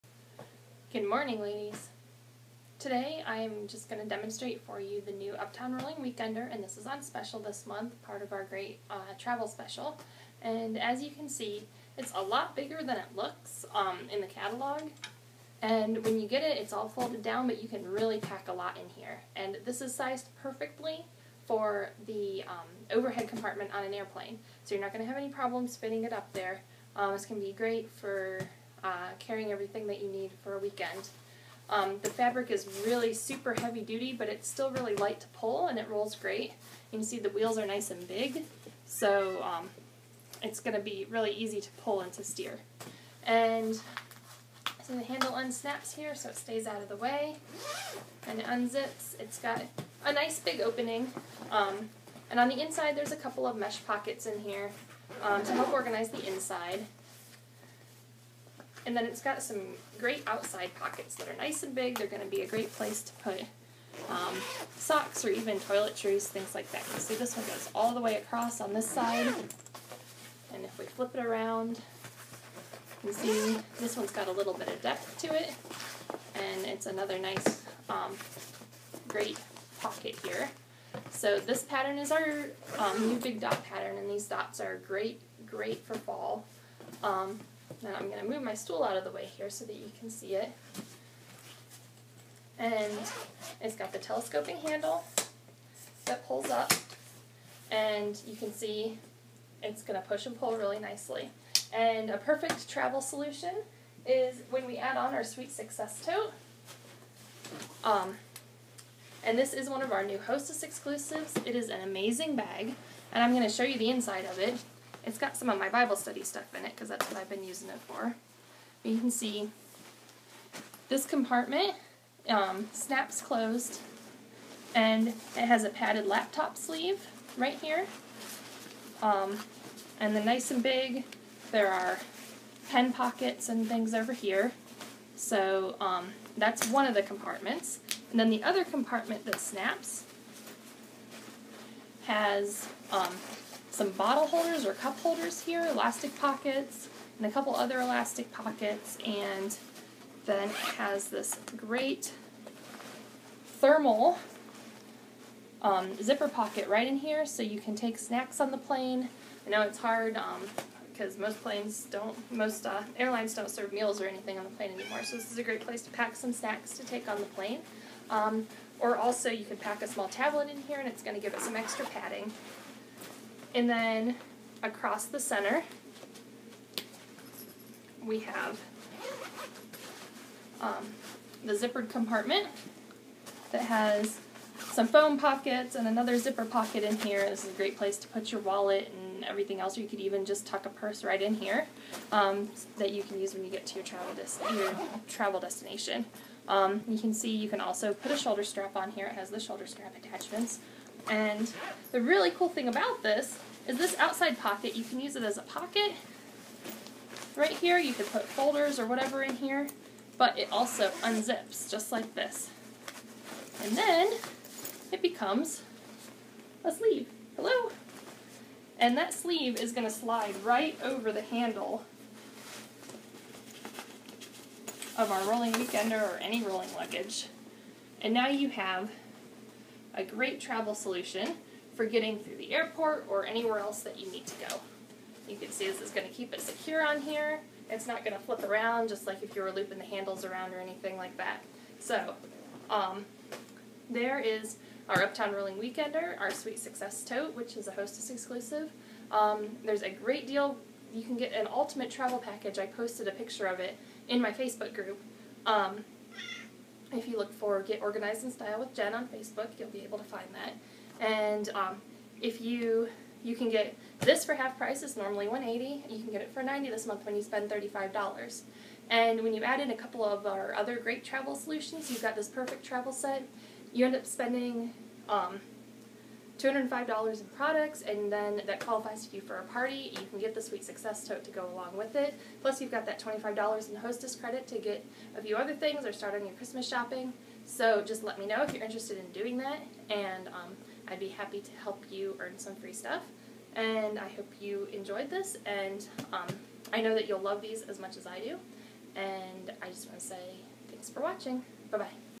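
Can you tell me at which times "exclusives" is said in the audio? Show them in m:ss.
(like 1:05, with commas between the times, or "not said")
1:50, 4:08.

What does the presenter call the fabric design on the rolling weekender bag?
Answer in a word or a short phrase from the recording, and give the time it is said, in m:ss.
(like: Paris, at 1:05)
big dot pattern, at 1:23.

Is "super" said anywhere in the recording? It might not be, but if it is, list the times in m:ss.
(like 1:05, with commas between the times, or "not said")
0:33.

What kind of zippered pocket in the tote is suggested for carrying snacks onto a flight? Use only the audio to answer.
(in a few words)
thermal.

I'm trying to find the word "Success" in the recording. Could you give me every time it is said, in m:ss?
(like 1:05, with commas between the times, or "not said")
1:45, 4:06, 4:40.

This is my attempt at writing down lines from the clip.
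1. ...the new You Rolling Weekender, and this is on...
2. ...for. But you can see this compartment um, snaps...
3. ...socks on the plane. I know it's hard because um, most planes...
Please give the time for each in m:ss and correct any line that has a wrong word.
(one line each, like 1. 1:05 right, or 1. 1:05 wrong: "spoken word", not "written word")
1. 0:04 wrong: "Uptown", not "You"
2. 1:57 right
3. 2:37 wrong: "snacks", not "socks".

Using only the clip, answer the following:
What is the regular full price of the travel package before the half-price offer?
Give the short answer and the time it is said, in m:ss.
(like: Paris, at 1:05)
180, at 4:25.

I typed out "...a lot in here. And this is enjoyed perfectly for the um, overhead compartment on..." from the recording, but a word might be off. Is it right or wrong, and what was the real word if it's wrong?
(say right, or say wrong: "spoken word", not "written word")
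wrong: "sized", not "enjoyed".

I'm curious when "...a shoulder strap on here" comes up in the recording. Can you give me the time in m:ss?
3:18.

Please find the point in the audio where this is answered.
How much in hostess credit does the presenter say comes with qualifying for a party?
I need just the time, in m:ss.
4:42.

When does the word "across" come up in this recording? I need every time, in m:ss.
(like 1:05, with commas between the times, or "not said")
1:08, 2:54.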